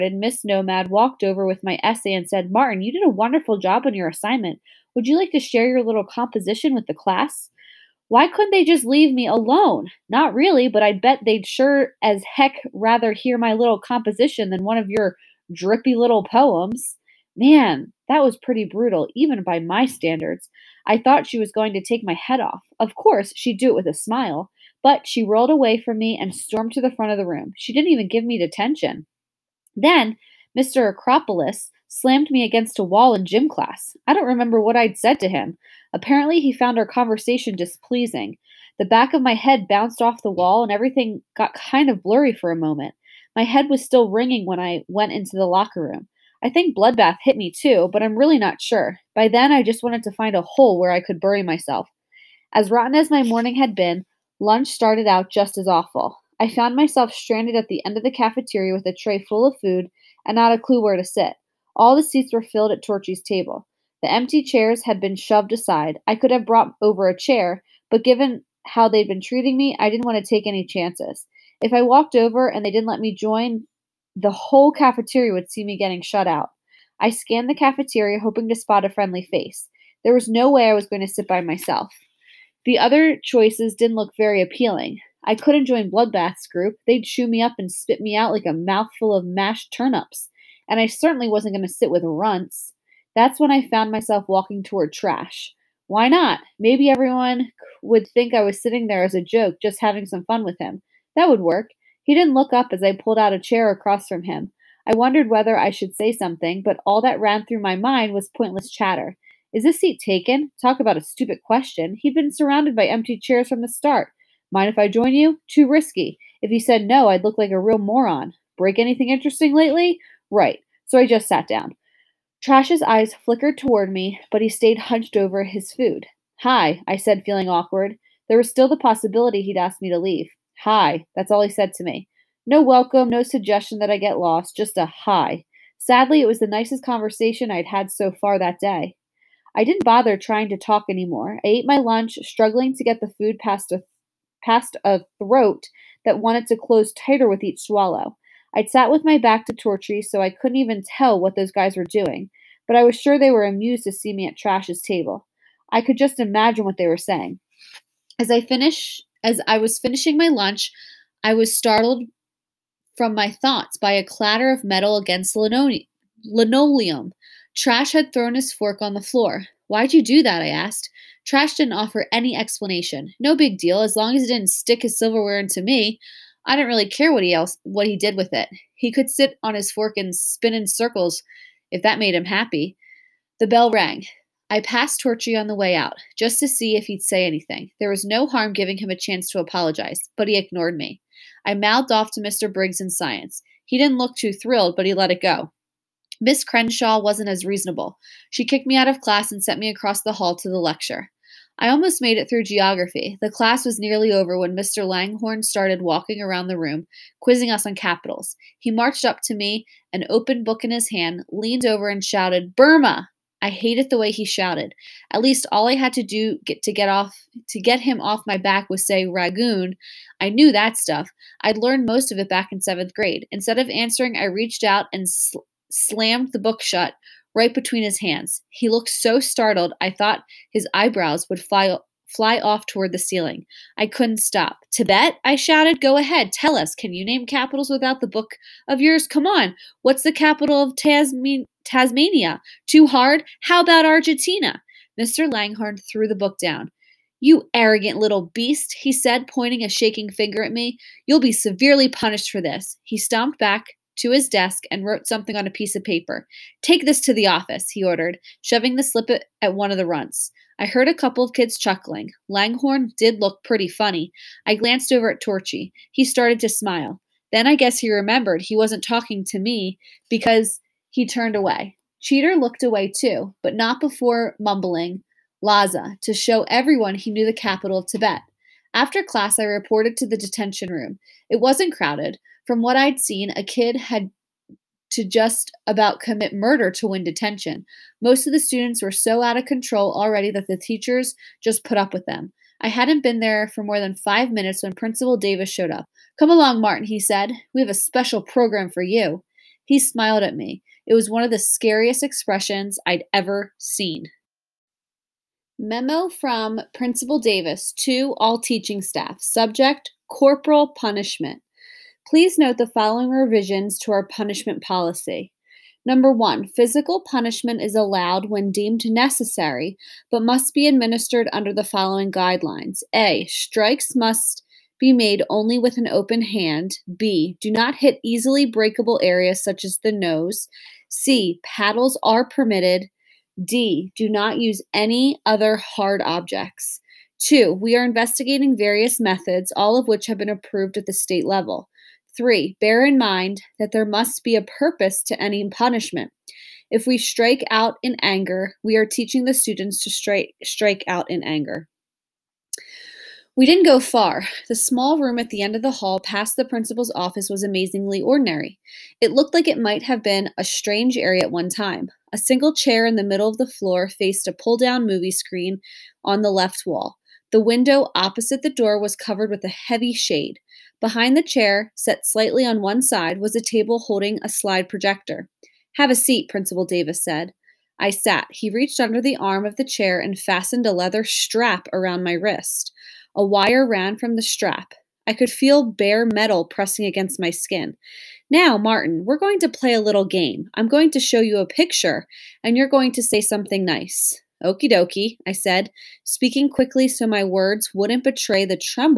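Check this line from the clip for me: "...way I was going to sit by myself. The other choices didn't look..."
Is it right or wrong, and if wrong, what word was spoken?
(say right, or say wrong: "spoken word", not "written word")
right.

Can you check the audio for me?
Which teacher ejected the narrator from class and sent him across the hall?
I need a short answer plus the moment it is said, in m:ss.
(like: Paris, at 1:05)
Miss Crenshaw, at 3:16.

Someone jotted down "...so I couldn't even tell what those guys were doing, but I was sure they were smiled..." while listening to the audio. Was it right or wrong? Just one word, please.
wrong.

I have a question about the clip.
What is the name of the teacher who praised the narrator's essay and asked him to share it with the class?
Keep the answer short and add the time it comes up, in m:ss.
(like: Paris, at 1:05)
Miss Nomad, at 0:00.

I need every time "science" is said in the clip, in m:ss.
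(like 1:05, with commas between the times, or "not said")
3:12.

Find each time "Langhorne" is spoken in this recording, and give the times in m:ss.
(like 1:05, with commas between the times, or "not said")
3:24, 4:05, 4:22.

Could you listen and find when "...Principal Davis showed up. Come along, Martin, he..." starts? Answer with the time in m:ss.
4:54.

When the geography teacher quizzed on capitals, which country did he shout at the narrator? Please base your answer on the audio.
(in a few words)
Burma.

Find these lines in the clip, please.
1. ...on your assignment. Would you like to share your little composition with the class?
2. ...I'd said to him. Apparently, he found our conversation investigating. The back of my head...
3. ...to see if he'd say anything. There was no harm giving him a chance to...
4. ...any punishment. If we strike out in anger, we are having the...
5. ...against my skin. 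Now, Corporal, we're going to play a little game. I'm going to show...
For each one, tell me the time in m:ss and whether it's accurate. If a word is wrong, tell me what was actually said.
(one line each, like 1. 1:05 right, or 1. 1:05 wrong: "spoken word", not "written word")
1. 0:03 right
2. 0:34 wrong: "displeasing", not "investigating"
3. 3:06 right
4. 5:45 wrong: "teaching", not "having"
5. 6:26 wrong: "Martin", not "Corporal".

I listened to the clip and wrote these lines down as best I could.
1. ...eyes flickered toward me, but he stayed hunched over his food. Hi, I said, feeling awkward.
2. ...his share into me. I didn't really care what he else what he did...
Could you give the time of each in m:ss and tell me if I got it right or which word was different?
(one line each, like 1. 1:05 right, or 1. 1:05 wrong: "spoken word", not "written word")
1. 2:02 right
2. 2:54 wrong: "silverware", not "share".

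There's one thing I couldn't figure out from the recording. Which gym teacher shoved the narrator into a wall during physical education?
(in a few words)
Mr. Acropolis.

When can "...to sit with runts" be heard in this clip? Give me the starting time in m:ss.
1:31.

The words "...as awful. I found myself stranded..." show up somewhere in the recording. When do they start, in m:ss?
0:55.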